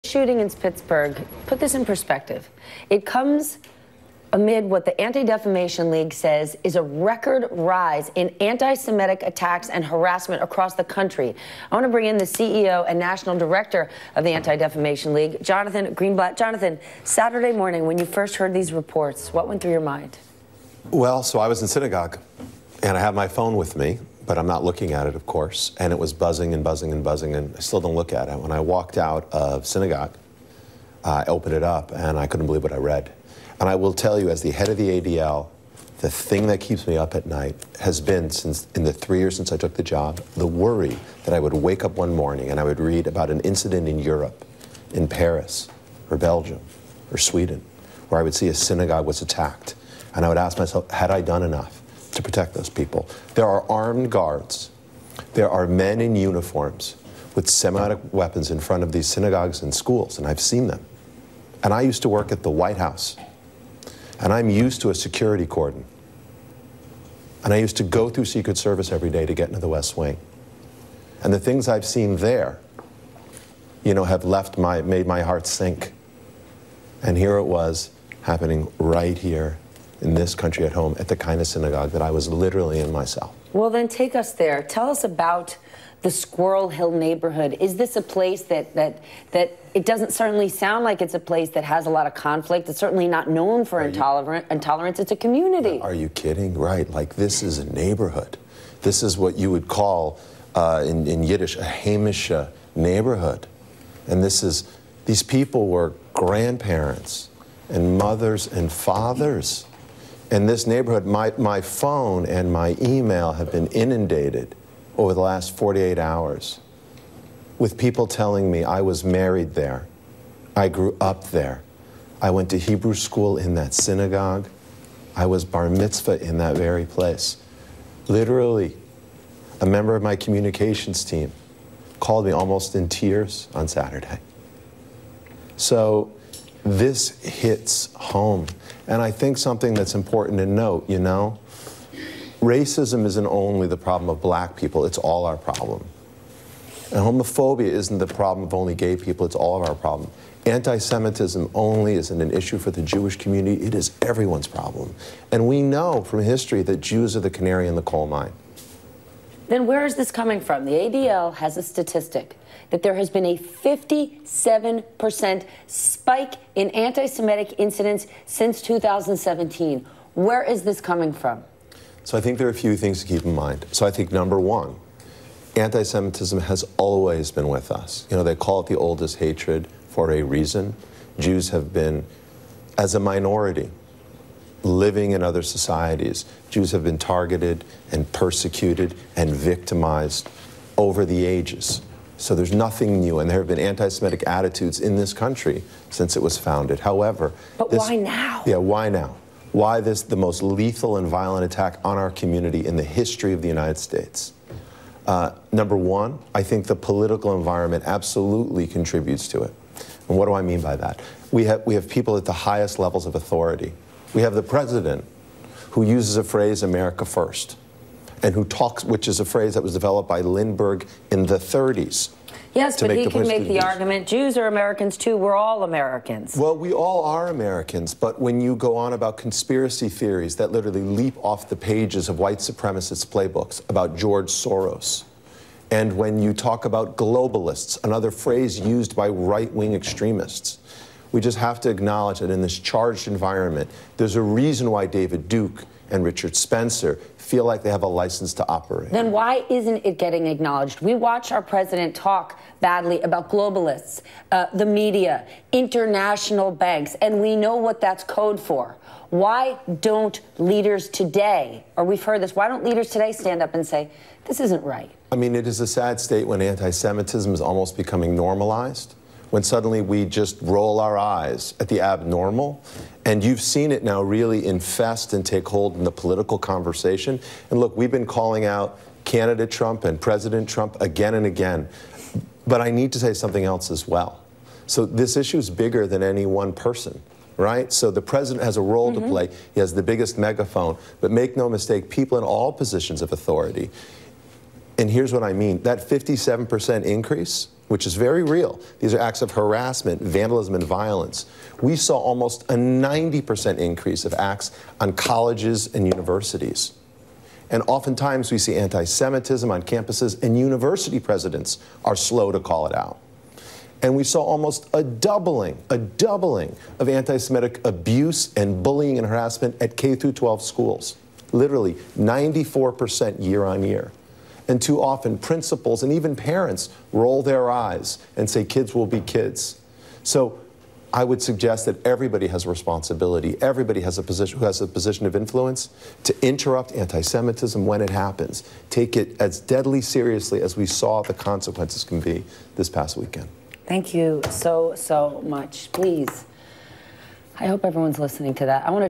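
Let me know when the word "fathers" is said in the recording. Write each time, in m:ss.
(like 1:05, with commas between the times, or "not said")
1:48.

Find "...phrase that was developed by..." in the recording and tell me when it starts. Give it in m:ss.
3:39.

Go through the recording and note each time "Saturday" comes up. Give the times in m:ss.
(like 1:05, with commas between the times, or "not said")
0:17, 2:13.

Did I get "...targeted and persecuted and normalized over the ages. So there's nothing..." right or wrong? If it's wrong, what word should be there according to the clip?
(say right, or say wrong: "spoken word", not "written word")
wrong: "victimized", not "normalized".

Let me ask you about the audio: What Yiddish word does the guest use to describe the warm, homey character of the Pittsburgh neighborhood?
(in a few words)
heimish.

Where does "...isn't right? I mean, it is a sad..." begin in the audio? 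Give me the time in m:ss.
4:24.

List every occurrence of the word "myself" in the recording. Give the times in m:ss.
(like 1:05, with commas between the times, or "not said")
0:50, 1:22.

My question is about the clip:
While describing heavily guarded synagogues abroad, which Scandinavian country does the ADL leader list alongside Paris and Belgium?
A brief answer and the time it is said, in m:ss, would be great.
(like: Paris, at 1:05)
Sweden, at 0:47.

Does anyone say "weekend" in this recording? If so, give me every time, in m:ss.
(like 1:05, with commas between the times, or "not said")
5:42.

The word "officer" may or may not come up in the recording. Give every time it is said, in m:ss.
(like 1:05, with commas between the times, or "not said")
not said.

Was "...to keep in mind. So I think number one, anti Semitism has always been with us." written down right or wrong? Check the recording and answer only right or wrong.
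right.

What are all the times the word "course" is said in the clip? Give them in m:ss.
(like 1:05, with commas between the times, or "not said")
0:25.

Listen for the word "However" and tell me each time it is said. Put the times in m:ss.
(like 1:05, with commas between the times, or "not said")
3:16.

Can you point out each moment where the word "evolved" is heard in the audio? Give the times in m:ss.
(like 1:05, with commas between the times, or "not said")
not said.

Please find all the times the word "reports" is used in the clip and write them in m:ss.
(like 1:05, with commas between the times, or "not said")
0:18.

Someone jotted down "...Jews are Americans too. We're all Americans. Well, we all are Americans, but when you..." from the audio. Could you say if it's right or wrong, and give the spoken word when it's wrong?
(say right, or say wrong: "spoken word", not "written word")
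right.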